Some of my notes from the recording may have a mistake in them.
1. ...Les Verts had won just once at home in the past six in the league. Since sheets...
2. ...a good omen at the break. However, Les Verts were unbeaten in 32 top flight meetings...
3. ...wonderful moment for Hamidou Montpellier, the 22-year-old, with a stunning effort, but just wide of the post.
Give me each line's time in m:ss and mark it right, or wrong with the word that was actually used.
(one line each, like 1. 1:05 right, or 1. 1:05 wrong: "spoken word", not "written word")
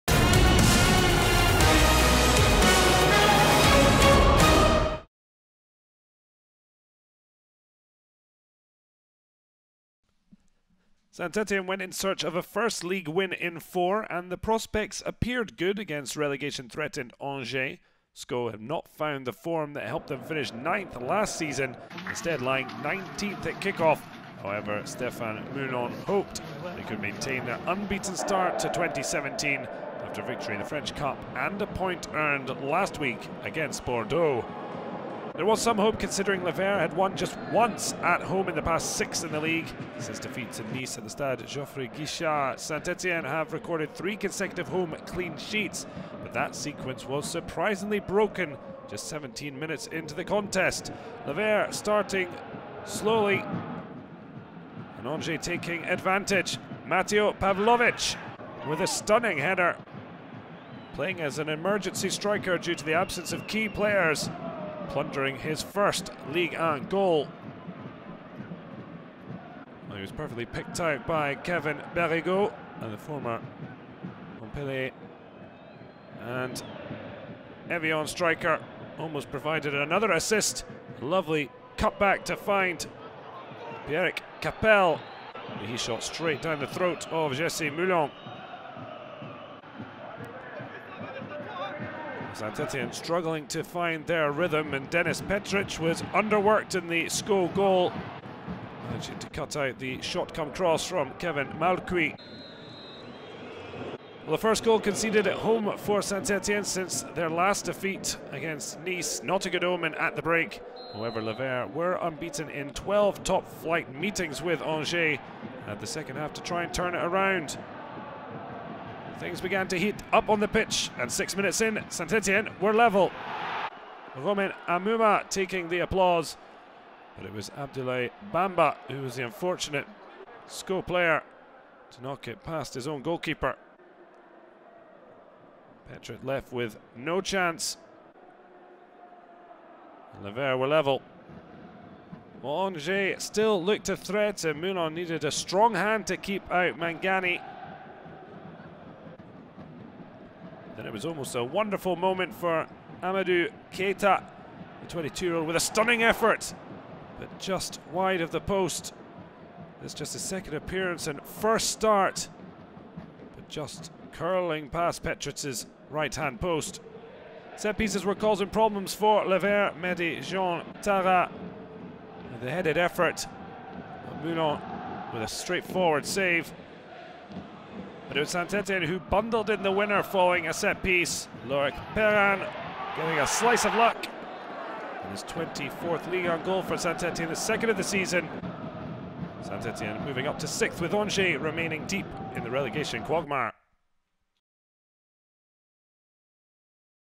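1. 0:36 wrong: "defeats", not "sheets"
2. 1:49 wrong: "12", not "32"
3. 2:31 wrong: "Keyta", not "Montpellier".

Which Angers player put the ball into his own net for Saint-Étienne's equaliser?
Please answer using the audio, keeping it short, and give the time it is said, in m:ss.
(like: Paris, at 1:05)
Abdoulaye Bamba, at 2:07.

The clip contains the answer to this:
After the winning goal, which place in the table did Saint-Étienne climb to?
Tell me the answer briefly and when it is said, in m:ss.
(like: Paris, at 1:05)
sixth, at 3:10.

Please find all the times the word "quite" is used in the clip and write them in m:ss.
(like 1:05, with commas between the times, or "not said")
not said.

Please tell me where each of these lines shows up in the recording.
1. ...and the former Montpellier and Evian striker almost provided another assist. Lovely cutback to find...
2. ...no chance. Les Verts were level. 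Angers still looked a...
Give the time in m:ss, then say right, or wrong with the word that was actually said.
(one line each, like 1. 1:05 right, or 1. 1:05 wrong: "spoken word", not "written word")
1. 1:12 right
2. 2:16 right.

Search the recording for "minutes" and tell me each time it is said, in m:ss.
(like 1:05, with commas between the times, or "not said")
0:49, 2:01.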